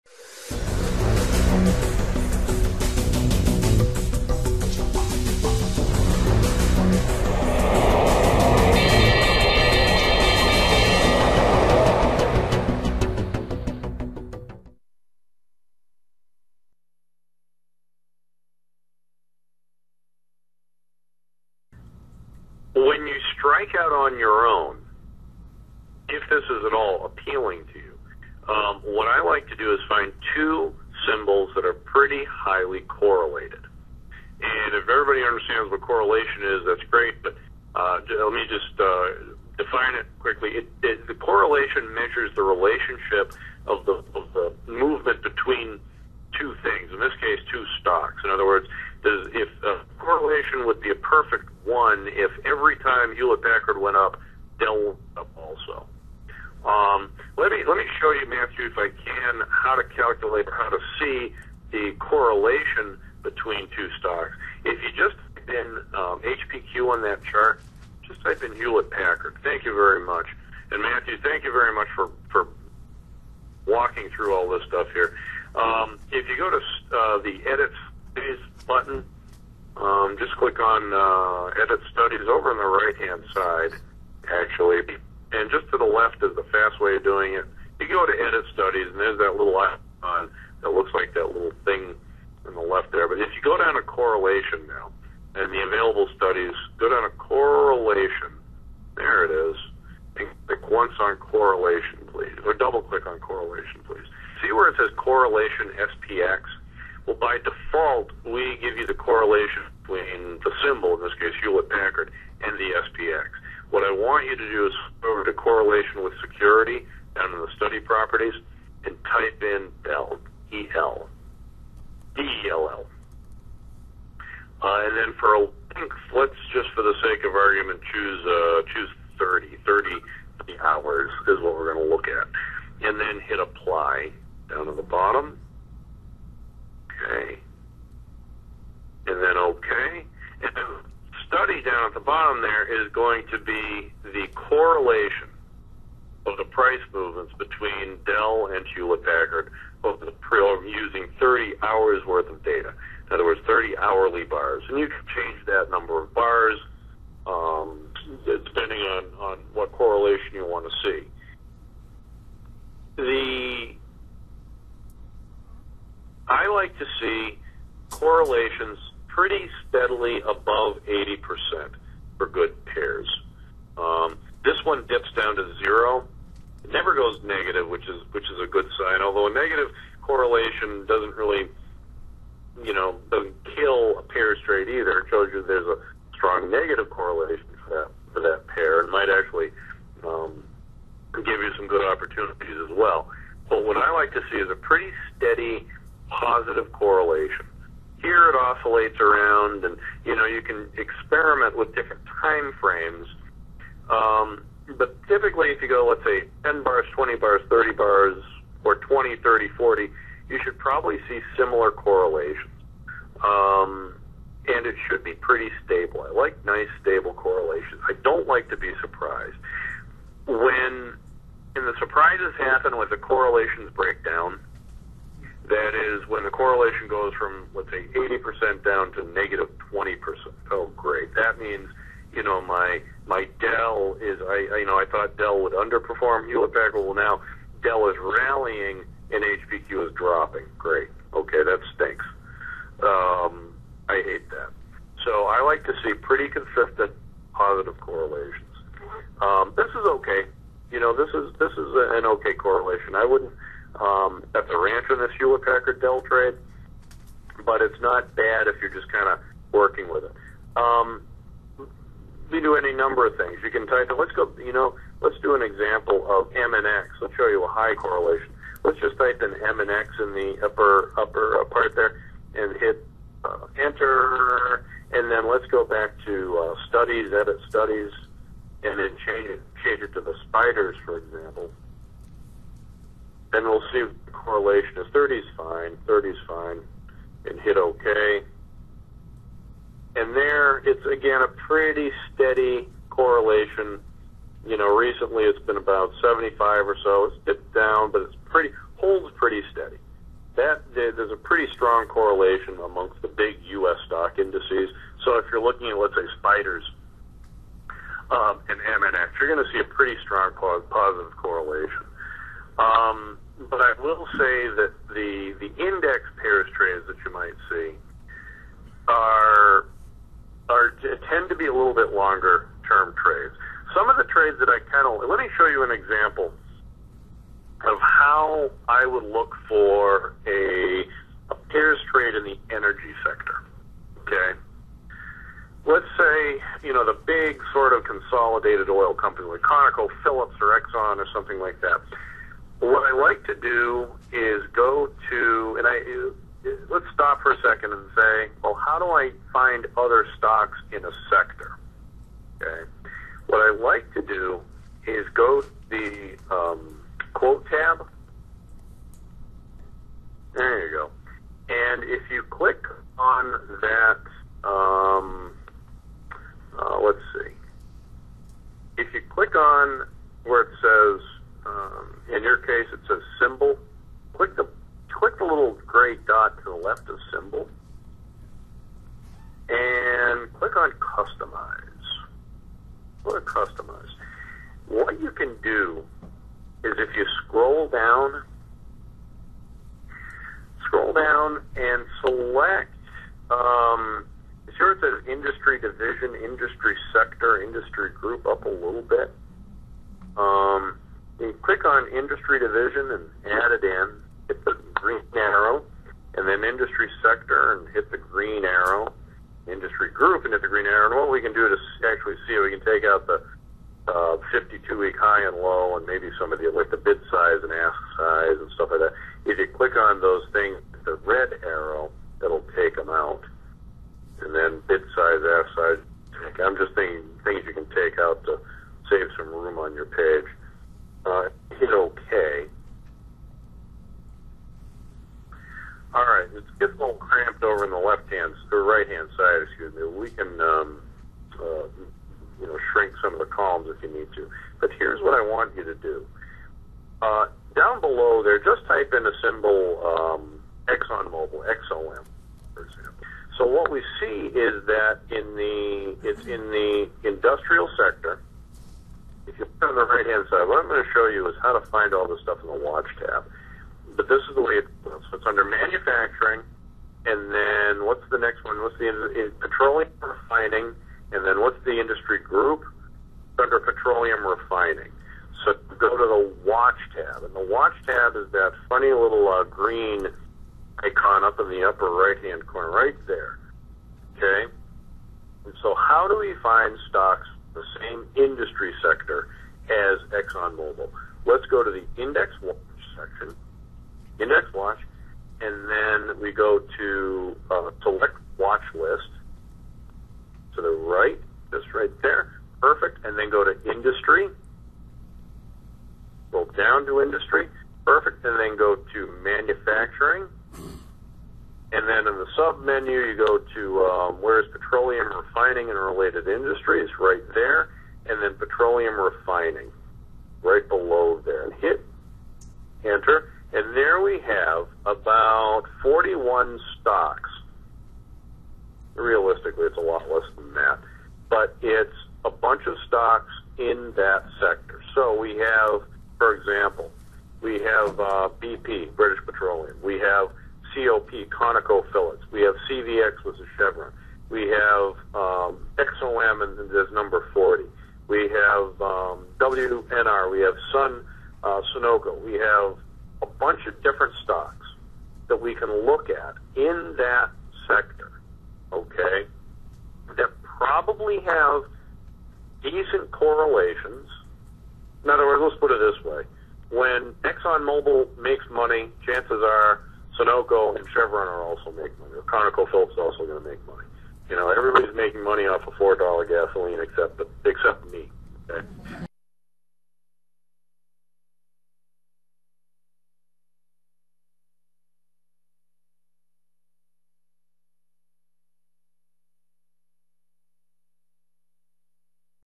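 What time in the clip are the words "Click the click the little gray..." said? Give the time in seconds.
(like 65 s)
374 s.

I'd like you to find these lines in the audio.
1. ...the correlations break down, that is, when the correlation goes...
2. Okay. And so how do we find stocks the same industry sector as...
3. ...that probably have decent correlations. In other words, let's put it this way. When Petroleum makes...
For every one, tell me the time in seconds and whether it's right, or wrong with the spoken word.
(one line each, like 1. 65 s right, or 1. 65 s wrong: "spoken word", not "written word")
1. 222 s right
2. 484 s right
3. 560 s wrong: "ExxonMobil", not "Petroleum".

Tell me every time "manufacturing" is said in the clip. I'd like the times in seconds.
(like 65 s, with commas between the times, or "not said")
465 s, 509 s.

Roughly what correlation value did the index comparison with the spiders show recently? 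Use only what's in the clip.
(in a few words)
75.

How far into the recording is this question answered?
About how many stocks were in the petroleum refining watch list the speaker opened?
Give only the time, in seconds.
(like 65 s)
524 s.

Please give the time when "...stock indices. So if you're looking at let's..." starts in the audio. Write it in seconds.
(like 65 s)
303 s.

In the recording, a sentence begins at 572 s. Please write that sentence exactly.
ConocoPhillips is also going to make money.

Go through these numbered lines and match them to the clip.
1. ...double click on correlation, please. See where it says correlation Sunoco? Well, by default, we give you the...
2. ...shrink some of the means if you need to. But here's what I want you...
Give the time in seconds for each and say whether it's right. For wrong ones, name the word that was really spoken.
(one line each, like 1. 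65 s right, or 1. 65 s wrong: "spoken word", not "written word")
1. 102 s wrong: "SPX", not "Sunoco"
2. 442 s wrong: "columns", not "means".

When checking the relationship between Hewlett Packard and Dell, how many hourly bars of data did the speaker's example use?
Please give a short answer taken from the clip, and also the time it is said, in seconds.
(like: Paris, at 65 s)
30, at 153 s.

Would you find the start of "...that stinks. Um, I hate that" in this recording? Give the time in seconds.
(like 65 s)
241 s.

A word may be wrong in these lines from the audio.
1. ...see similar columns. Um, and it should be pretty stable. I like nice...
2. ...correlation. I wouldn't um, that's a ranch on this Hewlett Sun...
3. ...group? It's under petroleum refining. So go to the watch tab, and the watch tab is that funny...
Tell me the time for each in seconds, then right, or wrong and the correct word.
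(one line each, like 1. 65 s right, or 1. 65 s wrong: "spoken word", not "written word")
1. 211 s wrong: "correlations", not "columns"
2. 252 s wrong: "Packard", not "Sun"
3. 472 s right.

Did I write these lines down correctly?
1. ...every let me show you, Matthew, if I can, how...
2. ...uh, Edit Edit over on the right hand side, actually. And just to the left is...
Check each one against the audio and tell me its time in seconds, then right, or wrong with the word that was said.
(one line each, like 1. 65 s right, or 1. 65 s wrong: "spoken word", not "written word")
1. 52 s right
2. 80 s wrong: "Studies", not "Edit".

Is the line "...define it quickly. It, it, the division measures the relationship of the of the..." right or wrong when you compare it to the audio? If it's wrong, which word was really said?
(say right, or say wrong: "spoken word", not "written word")
wrong: "correlation", not "division".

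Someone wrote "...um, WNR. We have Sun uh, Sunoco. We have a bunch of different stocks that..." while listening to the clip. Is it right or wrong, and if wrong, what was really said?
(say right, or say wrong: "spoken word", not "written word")
right.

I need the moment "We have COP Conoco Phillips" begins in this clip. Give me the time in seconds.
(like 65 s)
539 s.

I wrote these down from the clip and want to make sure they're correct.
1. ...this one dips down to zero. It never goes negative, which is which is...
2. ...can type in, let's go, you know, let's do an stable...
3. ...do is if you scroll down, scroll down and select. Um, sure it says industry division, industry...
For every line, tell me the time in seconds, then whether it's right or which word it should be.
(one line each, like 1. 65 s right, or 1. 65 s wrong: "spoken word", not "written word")
1. 174 s right
2. 263 s wrong: "example", not "stable"
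3. 385 s right.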